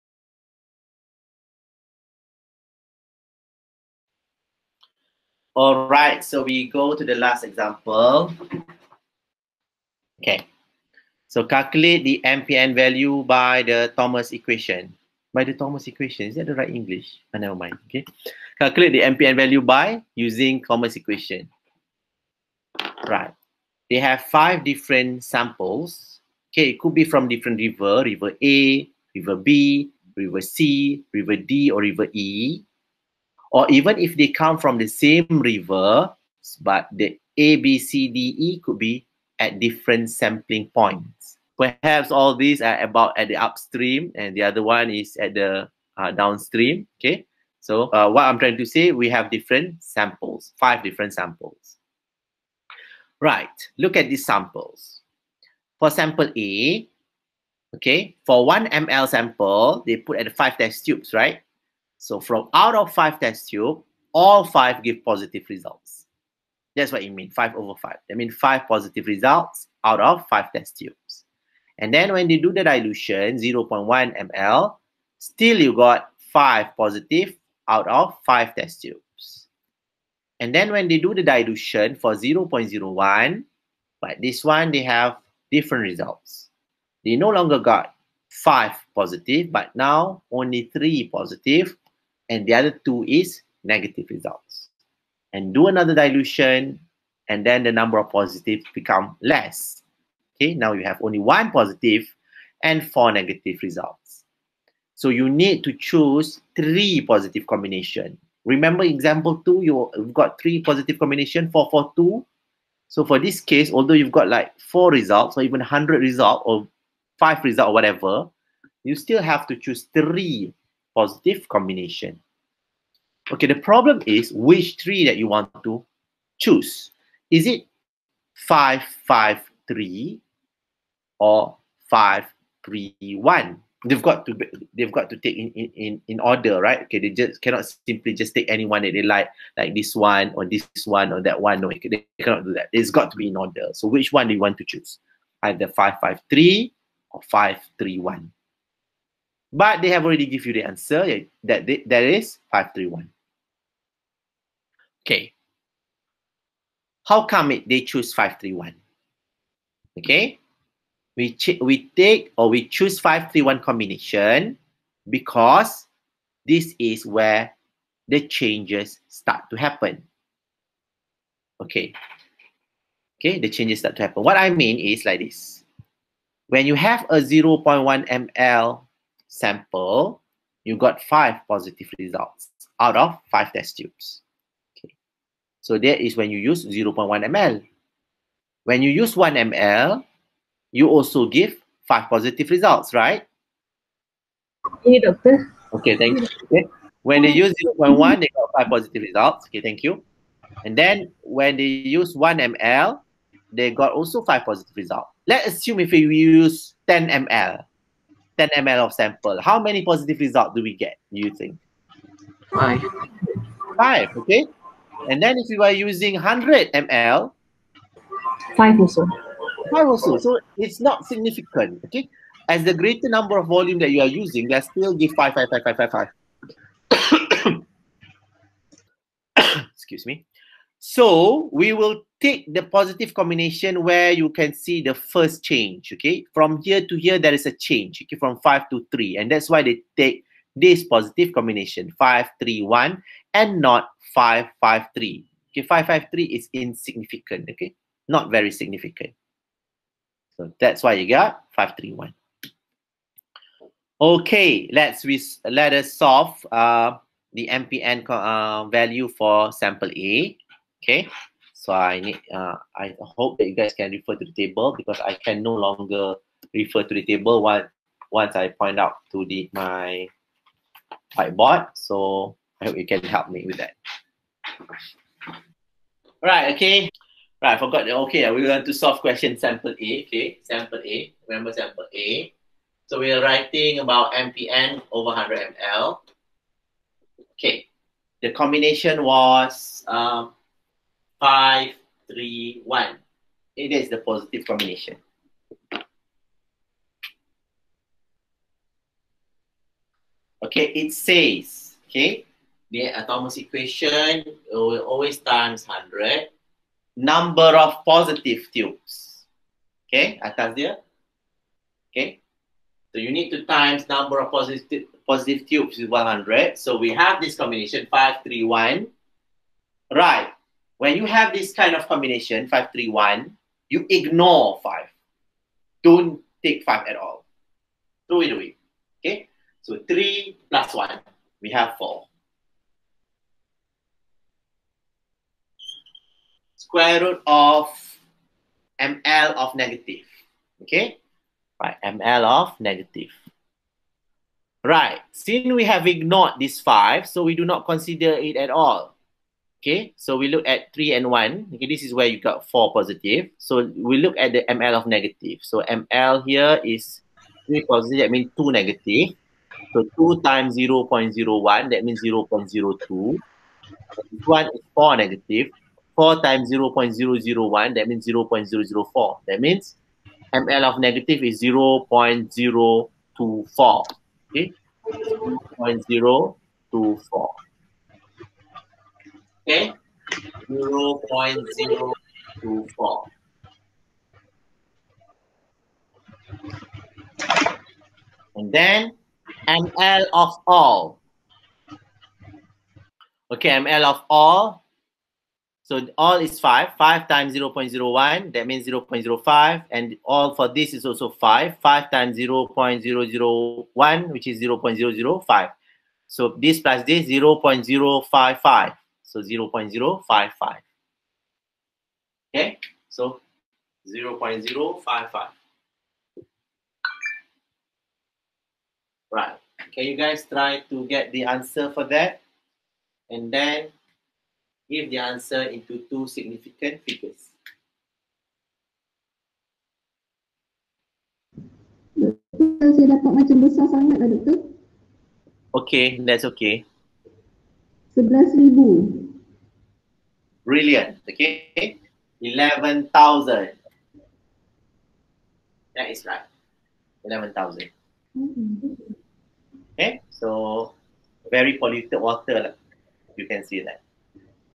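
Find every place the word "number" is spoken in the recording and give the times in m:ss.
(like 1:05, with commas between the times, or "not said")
1:37, 3:43, 5:06, 5:13.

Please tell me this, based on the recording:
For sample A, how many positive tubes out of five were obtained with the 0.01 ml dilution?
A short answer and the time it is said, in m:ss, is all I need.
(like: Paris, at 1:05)
3, at 1:29.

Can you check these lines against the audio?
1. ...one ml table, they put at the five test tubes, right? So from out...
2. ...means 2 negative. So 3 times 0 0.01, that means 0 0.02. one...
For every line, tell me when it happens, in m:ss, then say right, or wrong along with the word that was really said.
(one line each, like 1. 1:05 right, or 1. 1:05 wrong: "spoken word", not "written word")
1. 0:58 wrong: "sample", not "table"
2. 5:58 wrong: "2", not "3".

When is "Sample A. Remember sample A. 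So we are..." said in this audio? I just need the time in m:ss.
4:40.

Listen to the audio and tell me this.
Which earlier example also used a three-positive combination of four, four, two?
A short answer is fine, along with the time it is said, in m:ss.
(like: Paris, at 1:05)
Example 2, at 1:48.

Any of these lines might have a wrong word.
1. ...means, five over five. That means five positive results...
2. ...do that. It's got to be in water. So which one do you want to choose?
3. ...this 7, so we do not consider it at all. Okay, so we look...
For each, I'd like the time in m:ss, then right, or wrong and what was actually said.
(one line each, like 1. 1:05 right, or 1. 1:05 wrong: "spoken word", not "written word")
1. 1:07 right
2. 2:22 wrong: "order", not "water"
3. 5:46 wrong: "5", not "7".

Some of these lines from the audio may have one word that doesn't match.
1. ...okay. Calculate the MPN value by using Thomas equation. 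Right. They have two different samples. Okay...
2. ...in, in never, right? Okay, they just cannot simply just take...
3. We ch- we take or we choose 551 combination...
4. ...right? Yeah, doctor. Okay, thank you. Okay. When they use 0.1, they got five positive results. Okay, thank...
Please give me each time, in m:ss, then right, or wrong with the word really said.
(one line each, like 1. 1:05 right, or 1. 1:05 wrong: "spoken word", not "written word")
1. 0:17 wrong: "five", not "two"
2. 2:15 wrong: "order", not "never"
3. 2:41 wrong: "531", not "551"
4. 3:12 right.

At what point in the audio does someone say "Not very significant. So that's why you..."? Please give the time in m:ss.
4:08.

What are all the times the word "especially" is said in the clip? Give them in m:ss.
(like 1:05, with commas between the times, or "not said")
not said.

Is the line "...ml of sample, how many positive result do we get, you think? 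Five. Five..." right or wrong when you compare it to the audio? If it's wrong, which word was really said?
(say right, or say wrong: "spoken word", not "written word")
right.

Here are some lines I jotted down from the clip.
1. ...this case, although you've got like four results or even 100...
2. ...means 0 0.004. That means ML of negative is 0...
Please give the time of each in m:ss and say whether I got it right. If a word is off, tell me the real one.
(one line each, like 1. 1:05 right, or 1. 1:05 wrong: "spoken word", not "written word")
1. 1:53 right
2. 6:07 right.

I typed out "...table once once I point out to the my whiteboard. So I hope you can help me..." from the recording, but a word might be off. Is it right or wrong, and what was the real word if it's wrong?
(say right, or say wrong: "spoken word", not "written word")
right.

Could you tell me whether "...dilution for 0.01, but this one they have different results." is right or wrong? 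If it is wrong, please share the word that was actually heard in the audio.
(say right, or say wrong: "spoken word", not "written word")
right.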